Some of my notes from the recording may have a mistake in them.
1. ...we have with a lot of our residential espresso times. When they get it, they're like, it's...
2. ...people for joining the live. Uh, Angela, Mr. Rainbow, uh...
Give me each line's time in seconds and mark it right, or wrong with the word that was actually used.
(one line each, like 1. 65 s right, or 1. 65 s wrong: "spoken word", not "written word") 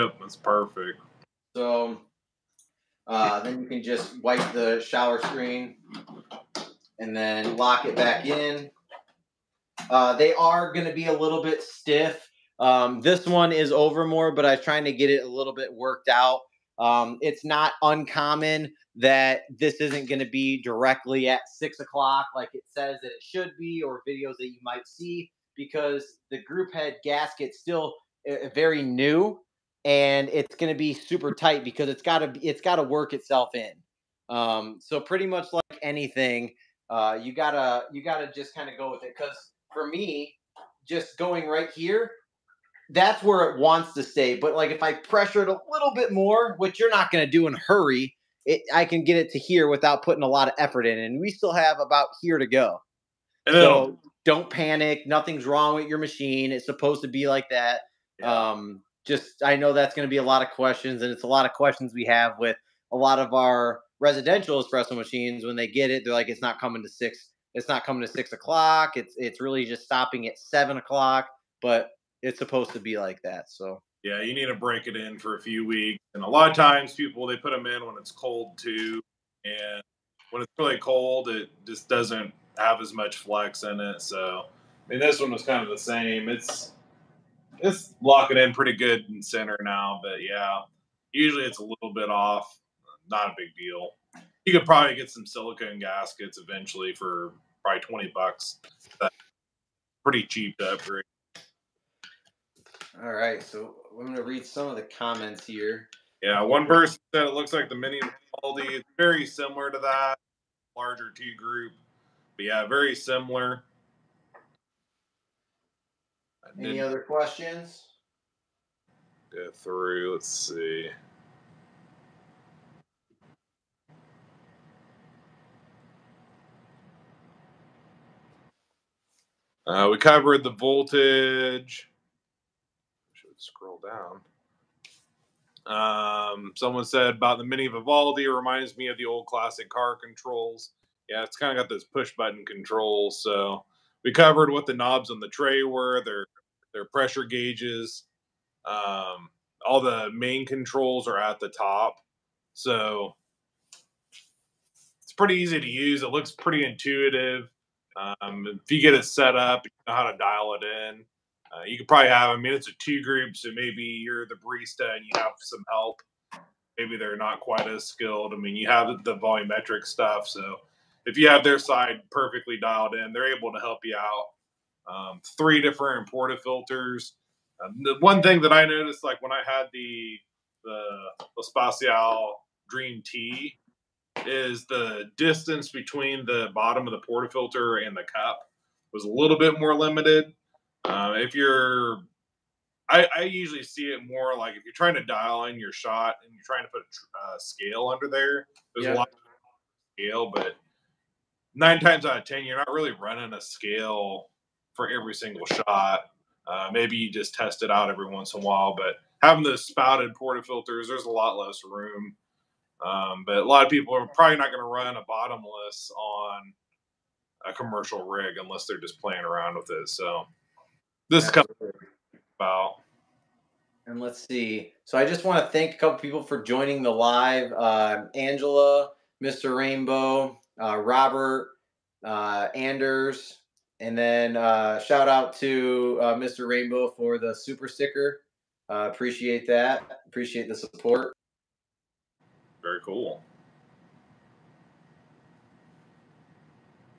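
1. 61 s wrong: "machines", not "times"
2. 225 s right.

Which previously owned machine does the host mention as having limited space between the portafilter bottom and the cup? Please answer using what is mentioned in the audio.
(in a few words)
Espacial Dream T.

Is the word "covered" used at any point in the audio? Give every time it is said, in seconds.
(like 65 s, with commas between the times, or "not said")
129 s, 144 s.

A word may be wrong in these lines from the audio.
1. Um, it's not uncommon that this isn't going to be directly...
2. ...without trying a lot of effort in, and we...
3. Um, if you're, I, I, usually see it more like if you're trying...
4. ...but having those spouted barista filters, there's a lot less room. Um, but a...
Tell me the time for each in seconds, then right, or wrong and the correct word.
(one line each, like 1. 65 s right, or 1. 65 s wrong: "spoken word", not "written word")
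1. 16 s right
2. 49 s wrong: "putting", not "trying"
3. 190 s right
4. 208 s wrong: "porta", not "barista".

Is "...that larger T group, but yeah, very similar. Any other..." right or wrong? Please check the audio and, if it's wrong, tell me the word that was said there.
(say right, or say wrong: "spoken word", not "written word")
right.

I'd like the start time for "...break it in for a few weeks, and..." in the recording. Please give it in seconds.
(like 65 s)
74 s.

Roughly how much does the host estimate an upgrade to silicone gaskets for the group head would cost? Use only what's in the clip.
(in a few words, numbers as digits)
$20.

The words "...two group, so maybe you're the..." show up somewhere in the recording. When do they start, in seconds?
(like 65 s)
162 s.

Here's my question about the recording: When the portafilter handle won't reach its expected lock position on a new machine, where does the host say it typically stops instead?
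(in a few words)
7 o'clock.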